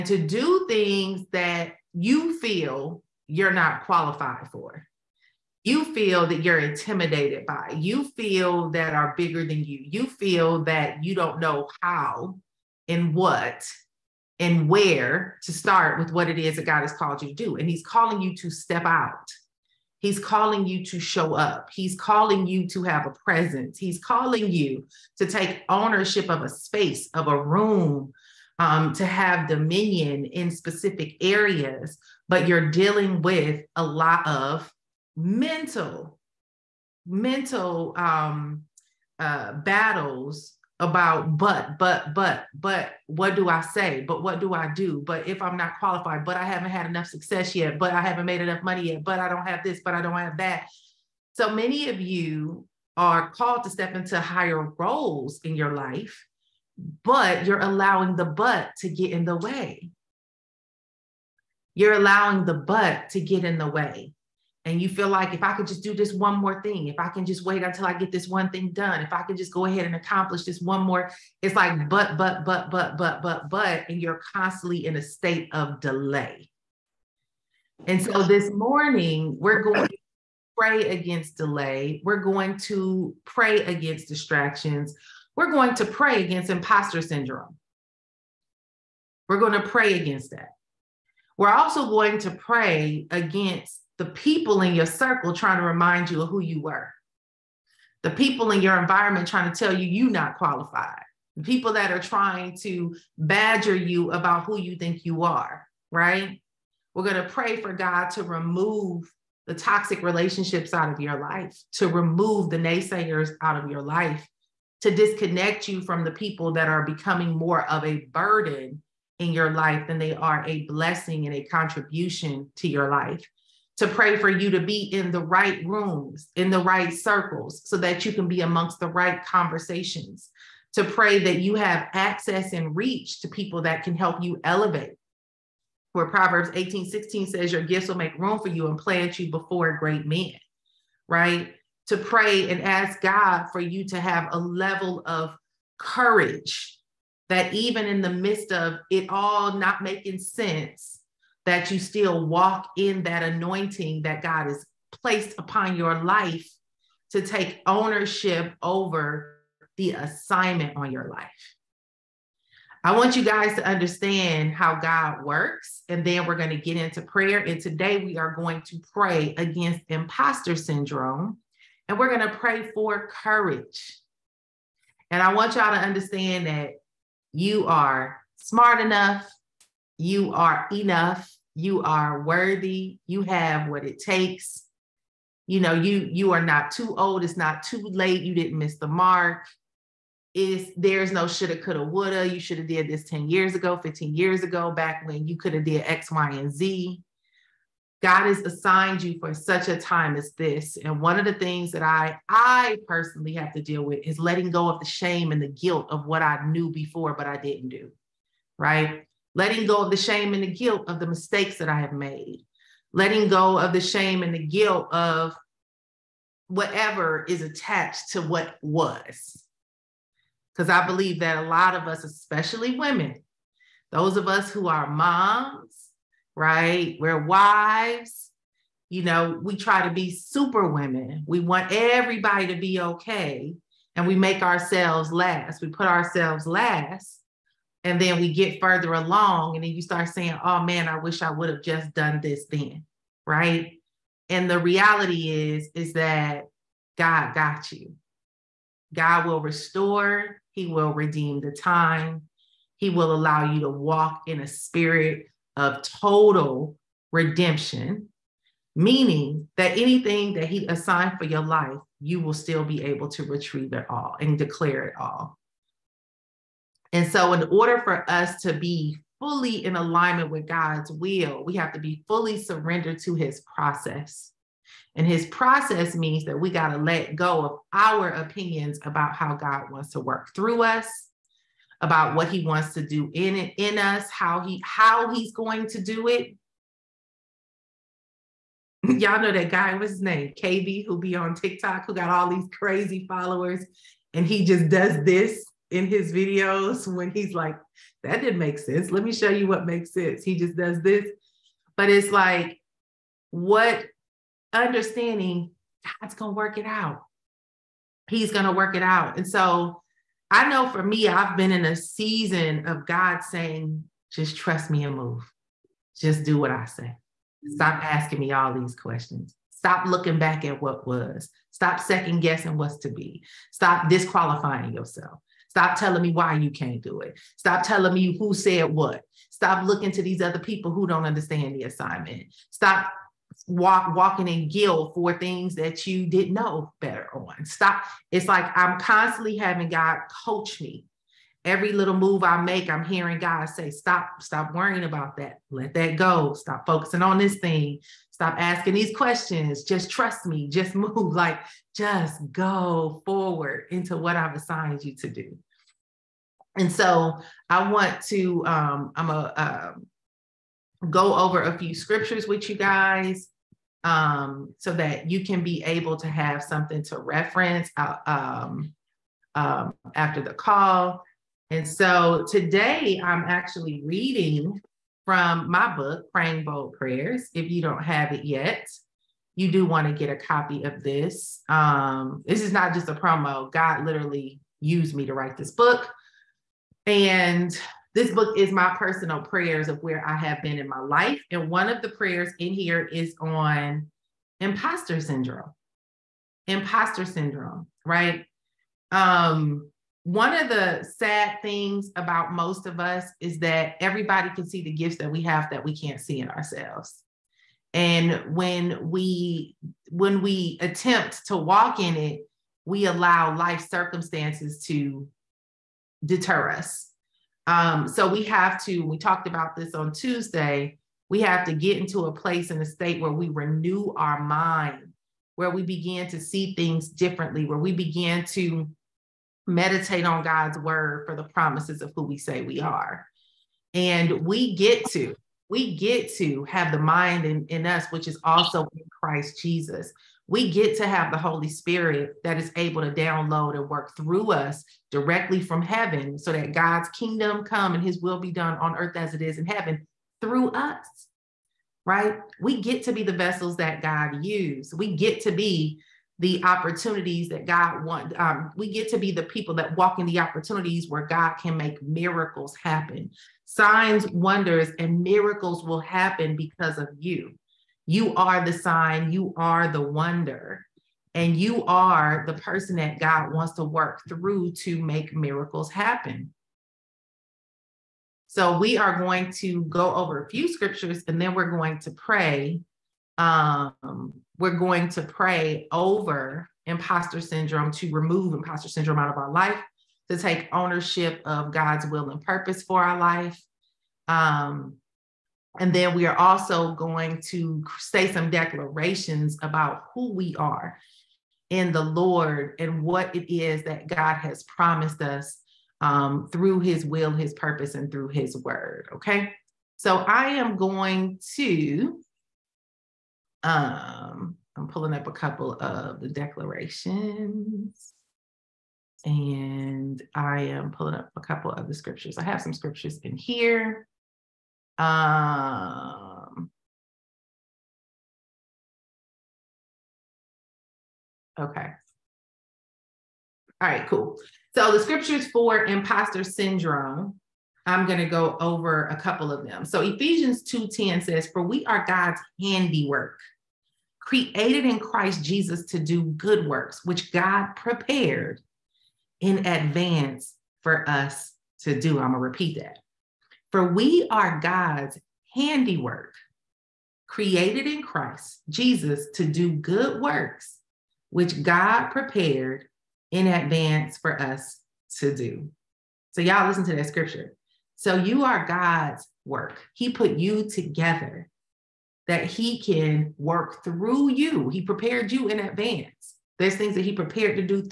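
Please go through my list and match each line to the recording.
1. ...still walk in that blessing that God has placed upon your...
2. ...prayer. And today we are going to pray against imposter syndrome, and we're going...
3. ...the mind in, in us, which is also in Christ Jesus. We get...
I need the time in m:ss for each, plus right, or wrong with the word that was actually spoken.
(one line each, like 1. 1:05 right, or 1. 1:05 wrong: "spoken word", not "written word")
1. 2:31 wrong: "anointing", not "blessing"
2. 2:46 right
3. 7:16 right.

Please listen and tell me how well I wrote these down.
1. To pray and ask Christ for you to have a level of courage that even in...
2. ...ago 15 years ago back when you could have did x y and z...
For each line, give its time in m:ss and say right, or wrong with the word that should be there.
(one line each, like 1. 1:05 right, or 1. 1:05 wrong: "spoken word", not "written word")
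1. 2:21 wrong: "God", not "Christ"
2. 3:13 right.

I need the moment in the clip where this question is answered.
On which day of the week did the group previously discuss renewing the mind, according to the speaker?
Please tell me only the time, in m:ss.
6:59.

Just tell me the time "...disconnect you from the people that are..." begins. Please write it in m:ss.
1:54.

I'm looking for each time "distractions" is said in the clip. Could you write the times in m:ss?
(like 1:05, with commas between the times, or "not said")
1:24.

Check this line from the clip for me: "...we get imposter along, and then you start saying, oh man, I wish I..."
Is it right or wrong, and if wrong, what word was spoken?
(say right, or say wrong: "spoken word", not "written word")
wrong: "further", not "imposter".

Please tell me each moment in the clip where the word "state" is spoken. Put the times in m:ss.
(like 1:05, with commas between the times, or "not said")
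1:15, 7:02.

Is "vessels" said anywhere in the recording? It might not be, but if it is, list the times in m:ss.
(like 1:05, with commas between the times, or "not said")
7:33.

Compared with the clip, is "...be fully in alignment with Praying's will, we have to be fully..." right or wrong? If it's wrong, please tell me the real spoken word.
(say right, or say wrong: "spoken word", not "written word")
wrong: "God", not "Praying".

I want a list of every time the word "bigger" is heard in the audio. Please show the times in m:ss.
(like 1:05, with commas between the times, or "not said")
0:09.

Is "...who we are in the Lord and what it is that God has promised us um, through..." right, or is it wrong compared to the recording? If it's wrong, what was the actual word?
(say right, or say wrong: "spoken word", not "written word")
right.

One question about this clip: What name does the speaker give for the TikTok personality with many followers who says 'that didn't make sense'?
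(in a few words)
KB.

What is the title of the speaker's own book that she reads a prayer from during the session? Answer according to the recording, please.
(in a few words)
Praying Bold Prayers.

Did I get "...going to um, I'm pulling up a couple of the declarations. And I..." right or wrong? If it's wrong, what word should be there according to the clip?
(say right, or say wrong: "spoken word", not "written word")
right.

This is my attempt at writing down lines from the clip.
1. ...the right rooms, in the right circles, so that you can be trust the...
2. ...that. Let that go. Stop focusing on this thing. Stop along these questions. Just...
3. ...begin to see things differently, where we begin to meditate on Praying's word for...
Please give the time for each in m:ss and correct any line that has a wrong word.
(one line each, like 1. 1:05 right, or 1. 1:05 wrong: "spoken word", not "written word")
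1. 2:05 wrong: "amongst", not "trust"
2. 5:45 wrong: "asking", not "along"
3. 7:05 wrong: "God", not "Praying".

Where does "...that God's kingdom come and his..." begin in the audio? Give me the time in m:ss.
7:26.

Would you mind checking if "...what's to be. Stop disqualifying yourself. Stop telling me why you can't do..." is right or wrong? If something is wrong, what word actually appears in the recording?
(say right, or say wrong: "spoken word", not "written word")
right.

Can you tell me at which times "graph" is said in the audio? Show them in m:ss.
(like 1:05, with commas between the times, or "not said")
not said.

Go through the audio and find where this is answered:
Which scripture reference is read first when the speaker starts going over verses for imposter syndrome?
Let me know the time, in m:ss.
8:59.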